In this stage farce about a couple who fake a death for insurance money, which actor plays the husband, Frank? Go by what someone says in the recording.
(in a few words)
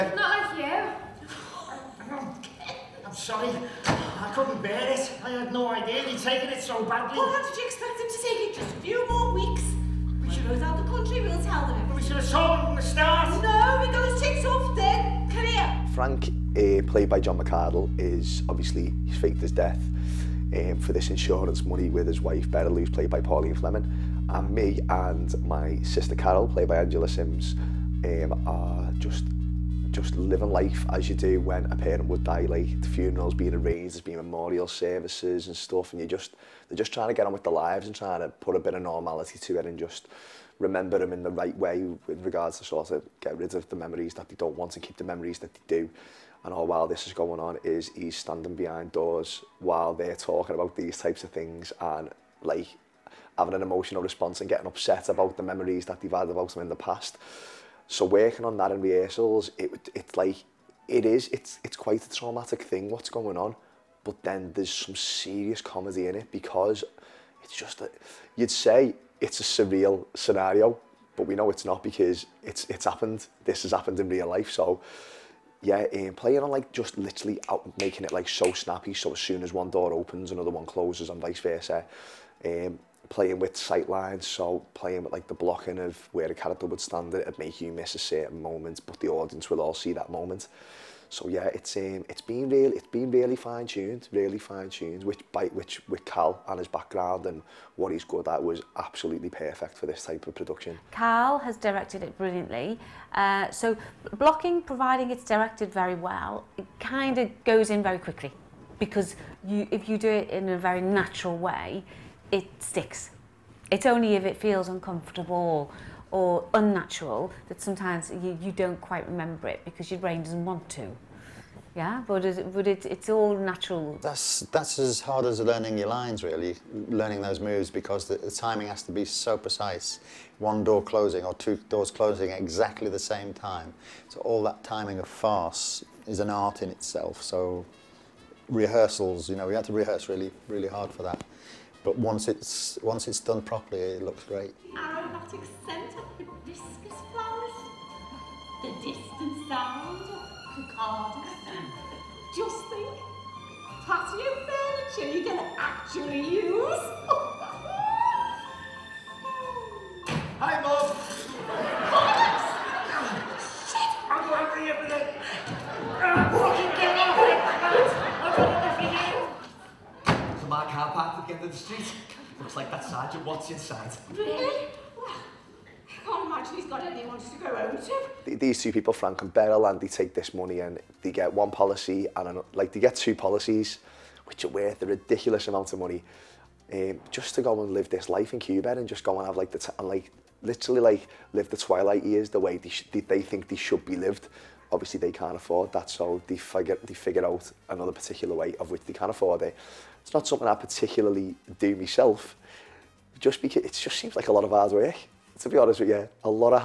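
John McArdle.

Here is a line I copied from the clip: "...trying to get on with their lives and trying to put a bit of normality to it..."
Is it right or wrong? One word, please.
right.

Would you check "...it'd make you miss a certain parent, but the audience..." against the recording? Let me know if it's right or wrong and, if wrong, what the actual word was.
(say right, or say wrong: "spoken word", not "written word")
wrong: "moment", not "parent".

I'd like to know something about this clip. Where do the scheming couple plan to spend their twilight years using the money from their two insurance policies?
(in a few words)
Cuba.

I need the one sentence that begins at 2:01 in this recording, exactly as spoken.
Yeah, but it, but it, it's all natural.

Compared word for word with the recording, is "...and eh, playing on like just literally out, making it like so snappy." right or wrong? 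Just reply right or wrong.
right.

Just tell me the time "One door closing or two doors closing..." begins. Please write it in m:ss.
2:10.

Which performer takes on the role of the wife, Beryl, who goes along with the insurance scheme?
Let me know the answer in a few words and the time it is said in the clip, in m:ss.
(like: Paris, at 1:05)
Pauline Fleming, at 0:23.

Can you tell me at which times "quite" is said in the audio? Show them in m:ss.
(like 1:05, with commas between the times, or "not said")
1:01, 1:58.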